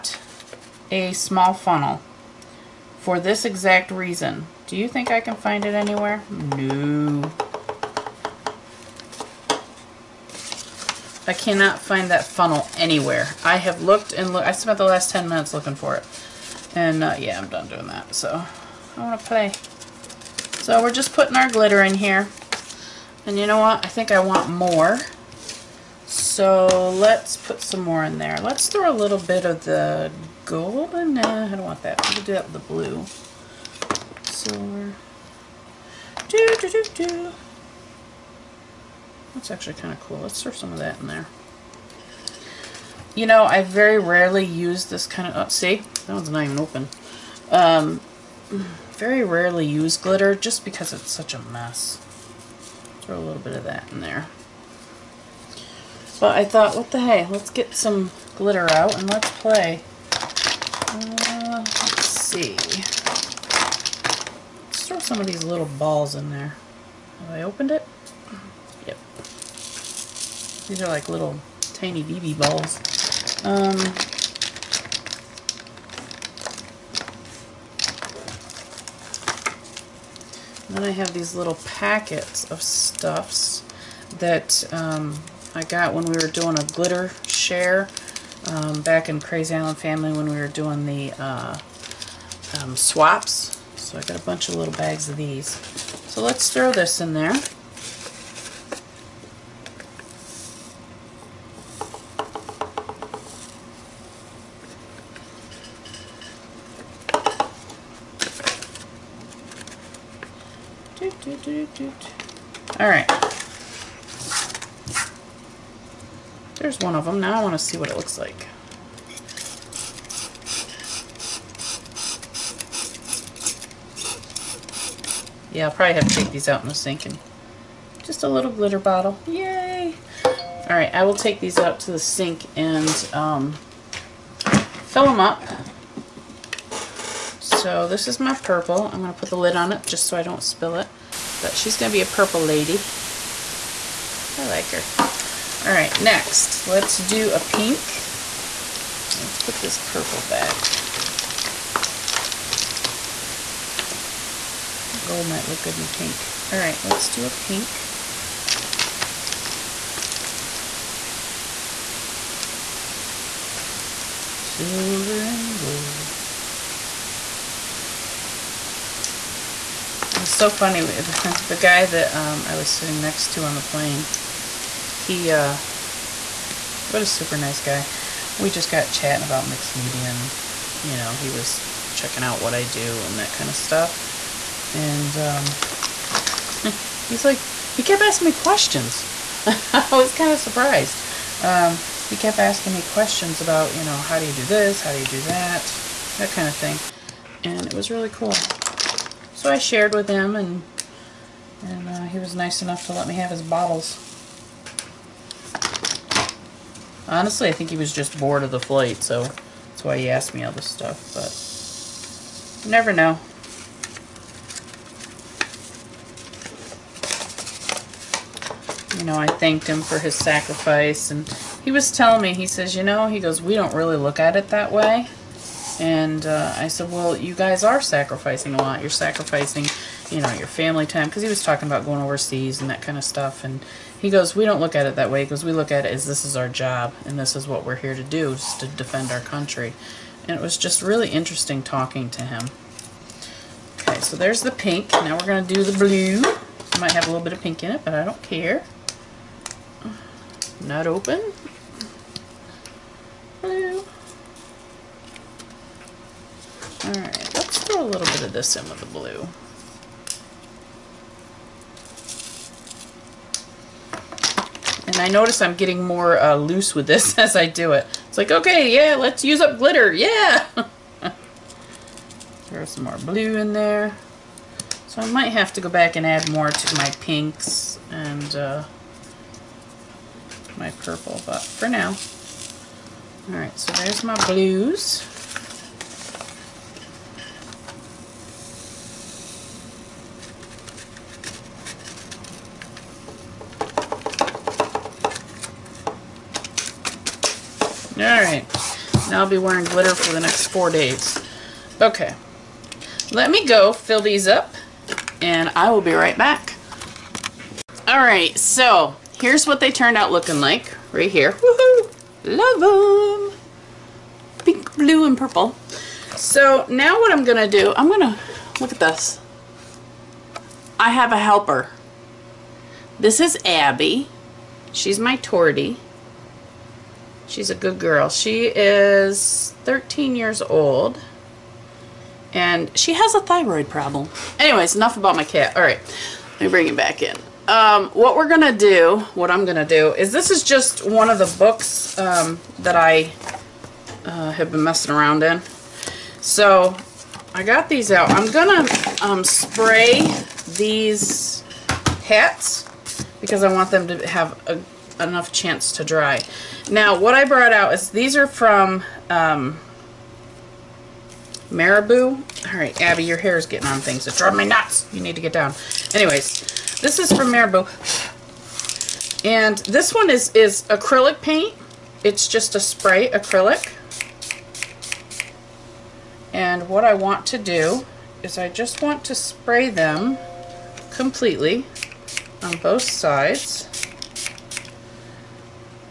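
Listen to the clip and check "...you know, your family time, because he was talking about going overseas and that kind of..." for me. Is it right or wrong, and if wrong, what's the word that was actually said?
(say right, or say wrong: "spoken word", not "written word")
right.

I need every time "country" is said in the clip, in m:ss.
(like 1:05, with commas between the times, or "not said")
3:59.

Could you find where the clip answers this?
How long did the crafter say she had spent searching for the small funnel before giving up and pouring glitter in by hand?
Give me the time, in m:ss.
0:15.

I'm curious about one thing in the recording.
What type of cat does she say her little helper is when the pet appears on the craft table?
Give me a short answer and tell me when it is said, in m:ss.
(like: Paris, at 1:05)
tortie, at 5:25.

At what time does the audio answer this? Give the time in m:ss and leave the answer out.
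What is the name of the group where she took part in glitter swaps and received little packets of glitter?
1:29.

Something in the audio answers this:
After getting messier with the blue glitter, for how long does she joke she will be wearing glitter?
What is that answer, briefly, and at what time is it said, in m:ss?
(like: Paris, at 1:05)
4 days, at 5:00.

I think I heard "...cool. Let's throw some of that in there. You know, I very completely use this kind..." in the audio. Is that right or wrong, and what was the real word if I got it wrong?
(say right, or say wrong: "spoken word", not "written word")
wrong: "rarely", not "completely".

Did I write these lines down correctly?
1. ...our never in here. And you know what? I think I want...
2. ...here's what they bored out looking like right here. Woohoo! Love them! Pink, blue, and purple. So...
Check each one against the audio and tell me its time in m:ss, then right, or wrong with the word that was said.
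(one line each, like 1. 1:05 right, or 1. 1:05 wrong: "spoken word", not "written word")
1. 0:21 wrong: "glitter", not "never"
2. 5:09 wrong: "turned", not "bored".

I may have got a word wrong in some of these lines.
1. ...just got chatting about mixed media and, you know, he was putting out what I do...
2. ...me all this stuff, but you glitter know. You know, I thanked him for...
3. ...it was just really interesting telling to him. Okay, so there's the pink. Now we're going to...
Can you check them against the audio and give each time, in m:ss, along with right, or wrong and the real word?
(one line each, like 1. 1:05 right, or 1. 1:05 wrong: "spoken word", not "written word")
1. 2:58 wrong: "checking", not "putting"
2. 3:30 wrong: "never", not "glitter"
3. 4:00 wrong: "talking", not "telling".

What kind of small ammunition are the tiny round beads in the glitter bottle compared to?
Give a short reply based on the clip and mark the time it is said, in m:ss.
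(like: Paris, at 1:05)
BB balls, at 1:12.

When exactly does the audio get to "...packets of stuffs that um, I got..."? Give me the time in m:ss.
1:21.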